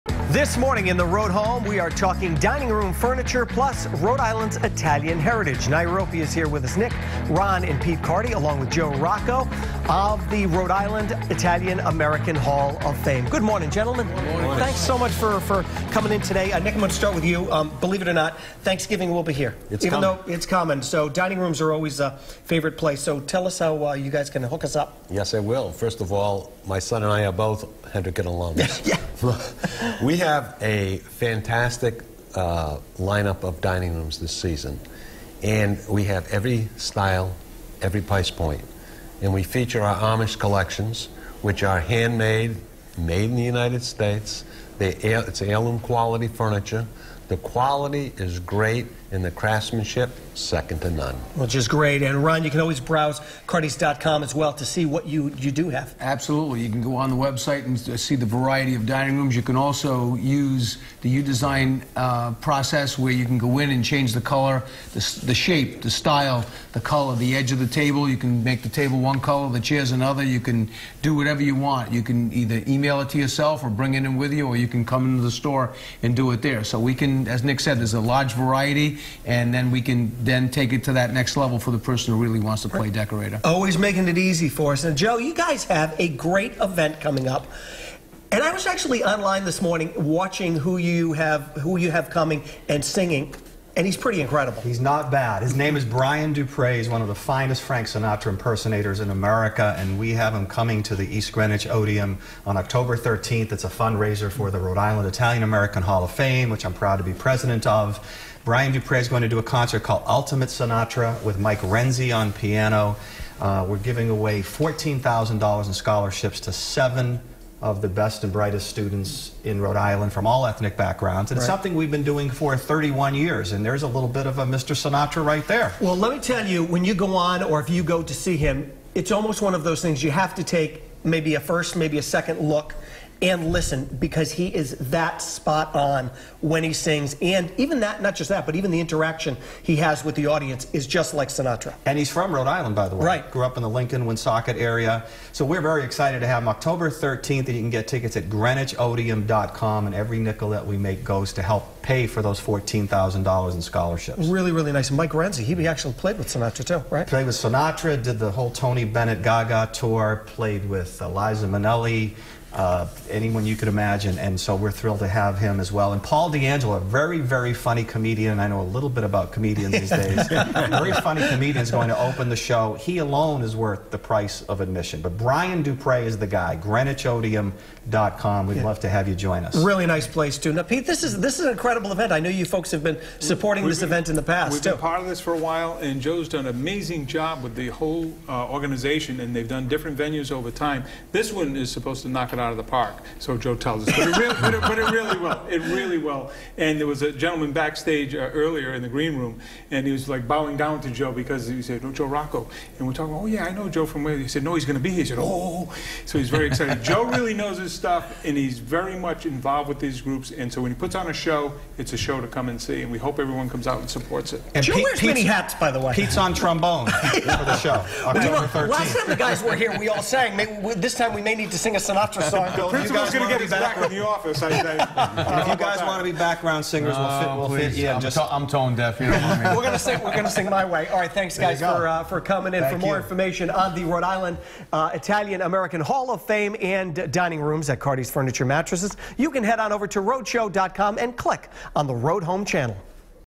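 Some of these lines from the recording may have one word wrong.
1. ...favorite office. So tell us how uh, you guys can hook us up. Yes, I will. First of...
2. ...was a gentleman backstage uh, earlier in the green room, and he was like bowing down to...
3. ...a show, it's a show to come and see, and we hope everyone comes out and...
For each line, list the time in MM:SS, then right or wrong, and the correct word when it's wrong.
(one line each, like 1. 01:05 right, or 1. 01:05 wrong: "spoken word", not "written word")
1. 00:22 wrong: "place", not "office"
2. 03:16 right
3. 03:31 right.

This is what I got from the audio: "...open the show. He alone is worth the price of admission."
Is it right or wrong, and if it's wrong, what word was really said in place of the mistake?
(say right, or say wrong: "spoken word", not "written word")
right.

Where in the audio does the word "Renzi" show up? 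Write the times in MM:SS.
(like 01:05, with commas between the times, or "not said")
01:51, 02:35.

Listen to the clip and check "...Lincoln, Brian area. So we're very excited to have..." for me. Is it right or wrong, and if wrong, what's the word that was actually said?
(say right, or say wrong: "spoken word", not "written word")
wrong: "Woonsocket", not "Brian".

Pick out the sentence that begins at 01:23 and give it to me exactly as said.
Always making it easy for us.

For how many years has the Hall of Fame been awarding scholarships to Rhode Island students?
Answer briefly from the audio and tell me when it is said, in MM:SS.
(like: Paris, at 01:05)
31 years, at 02:02.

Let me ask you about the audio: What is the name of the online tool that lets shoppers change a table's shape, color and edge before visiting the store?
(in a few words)
U-Design.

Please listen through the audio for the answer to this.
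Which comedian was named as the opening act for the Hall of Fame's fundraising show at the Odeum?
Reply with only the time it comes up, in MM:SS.
02:46.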